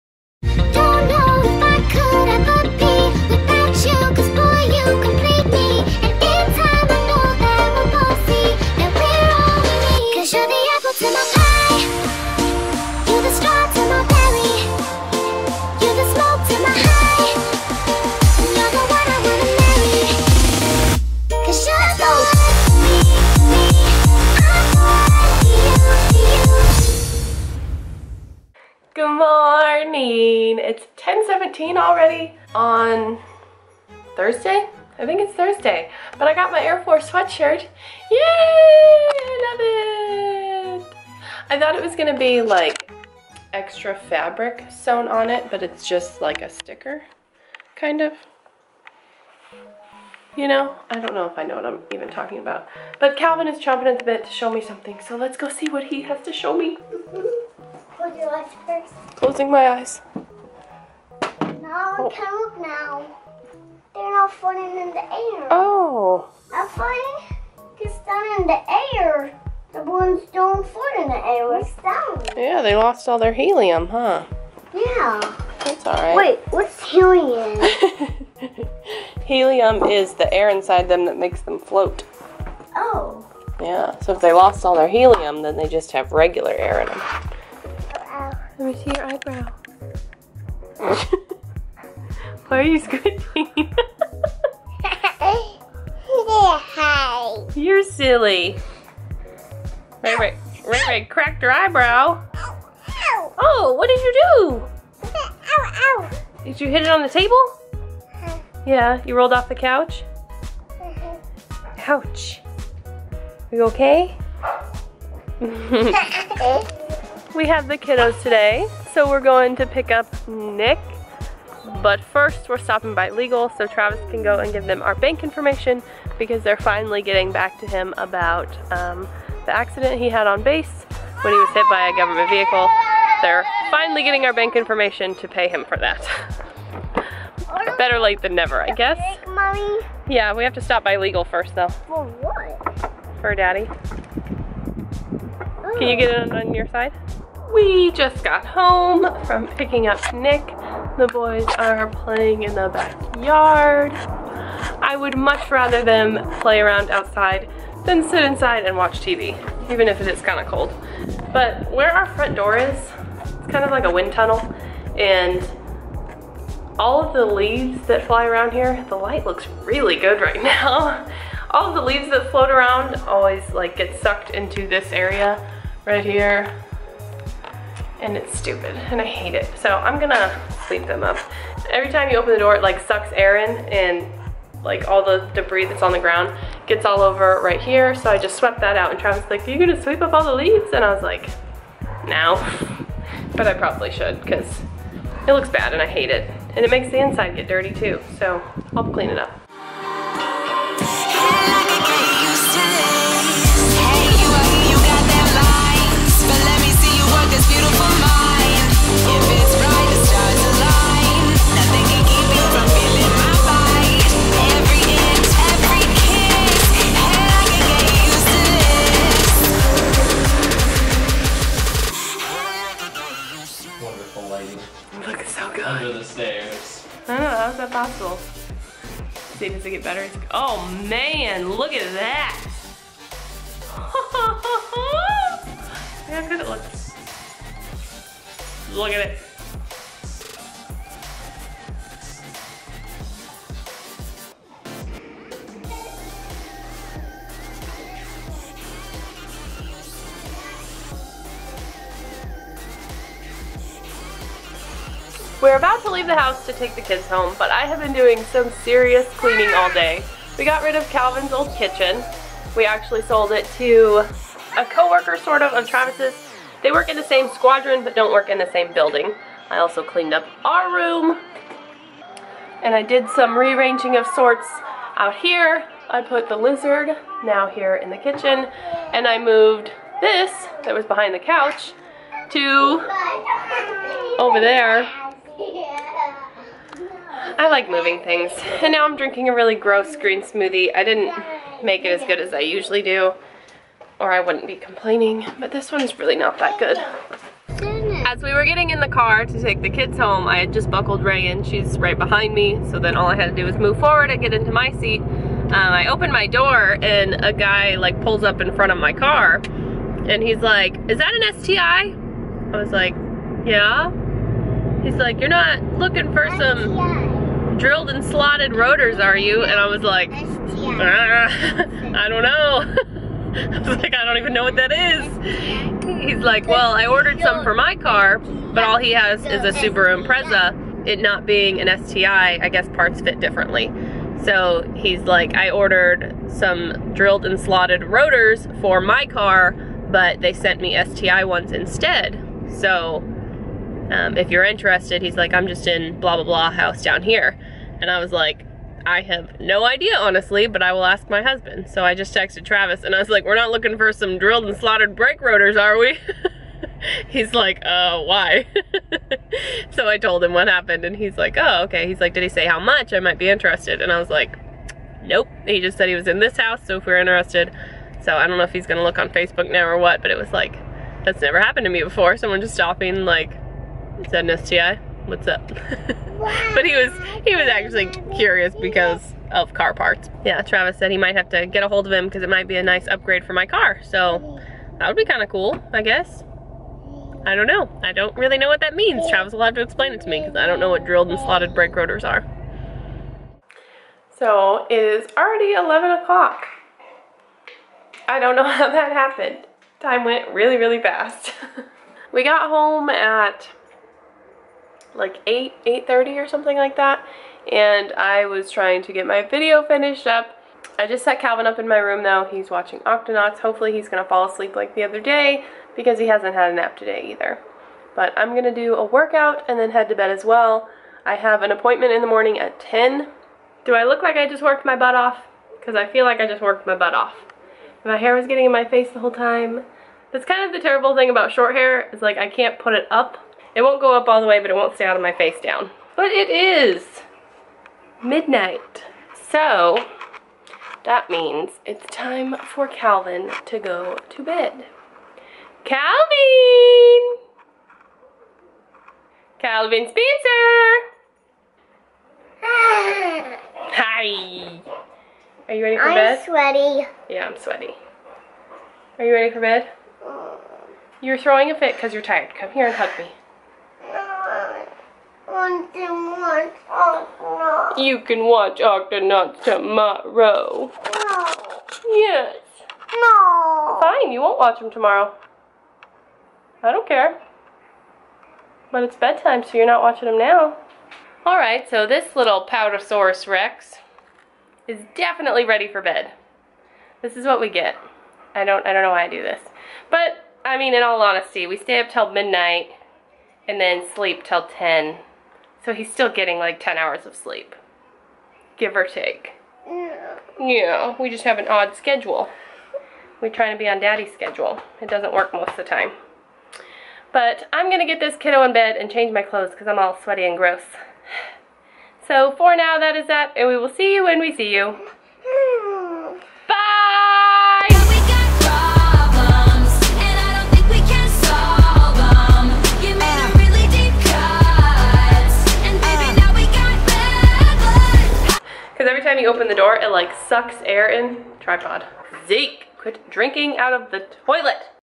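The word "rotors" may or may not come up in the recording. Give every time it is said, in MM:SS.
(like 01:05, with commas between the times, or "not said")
05:18, 05:37, 05:55, 06:31.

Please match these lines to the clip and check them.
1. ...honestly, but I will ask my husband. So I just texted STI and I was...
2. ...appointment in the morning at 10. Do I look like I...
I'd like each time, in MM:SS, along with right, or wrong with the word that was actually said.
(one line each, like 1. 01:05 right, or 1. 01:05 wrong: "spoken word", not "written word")
1. 05:49 wrong: "Travis", not "STI"
2. 07:01 right.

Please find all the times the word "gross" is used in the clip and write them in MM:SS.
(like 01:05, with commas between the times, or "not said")
04:49, 08:30.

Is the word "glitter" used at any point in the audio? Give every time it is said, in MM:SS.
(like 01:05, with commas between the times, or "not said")
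not said.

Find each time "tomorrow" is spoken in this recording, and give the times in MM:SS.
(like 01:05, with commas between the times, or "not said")
07:49, 07:54.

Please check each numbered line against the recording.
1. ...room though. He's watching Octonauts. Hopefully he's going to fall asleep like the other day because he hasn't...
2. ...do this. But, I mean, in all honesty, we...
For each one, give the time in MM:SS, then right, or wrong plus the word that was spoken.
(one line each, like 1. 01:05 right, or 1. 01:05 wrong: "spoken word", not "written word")
1. 06:51 right
2. 08:09 right.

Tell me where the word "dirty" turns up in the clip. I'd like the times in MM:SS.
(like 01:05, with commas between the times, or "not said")
03:17.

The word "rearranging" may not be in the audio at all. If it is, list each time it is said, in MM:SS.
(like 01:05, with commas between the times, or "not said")
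04:33.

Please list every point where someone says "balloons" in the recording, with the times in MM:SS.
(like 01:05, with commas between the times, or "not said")
01:09.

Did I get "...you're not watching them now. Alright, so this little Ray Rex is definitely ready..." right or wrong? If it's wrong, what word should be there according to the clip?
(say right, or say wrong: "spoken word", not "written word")
wrong: "Powdersaurus", not "Ray".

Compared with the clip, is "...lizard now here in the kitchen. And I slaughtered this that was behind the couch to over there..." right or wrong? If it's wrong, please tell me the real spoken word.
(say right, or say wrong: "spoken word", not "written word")
wrong: "moved", not "slaughtered".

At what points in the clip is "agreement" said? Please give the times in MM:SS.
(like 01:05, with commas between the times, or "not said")
not said.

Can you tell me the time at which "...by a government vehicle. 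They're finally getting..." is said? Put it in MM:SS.
02:11.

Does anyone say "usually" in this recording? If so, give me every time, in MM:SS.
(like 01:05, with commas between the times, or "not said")
04:52.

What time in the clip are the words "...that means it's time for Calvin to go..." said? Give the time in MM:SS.
07:20.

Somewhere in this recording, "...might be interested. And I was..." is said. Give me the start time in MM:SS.
06:02.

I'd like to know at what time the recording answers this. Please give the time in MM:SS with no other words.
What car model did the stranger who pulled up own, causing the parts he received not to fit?
05:29.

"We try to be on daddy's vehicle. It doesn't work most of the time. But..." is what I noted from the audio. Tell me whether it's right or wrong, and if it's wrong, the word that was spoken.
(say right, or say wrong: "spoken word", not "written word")
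wrong: "schedule", not "vehicle".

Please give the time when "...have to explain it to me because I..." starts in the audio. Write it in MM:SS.
06:29.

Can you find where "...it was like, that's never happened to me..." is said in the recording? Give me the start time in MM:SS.
06:10.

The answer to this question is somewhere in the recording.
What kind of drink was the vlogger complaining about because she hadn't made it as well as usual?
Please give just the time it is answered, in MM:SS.
04:49.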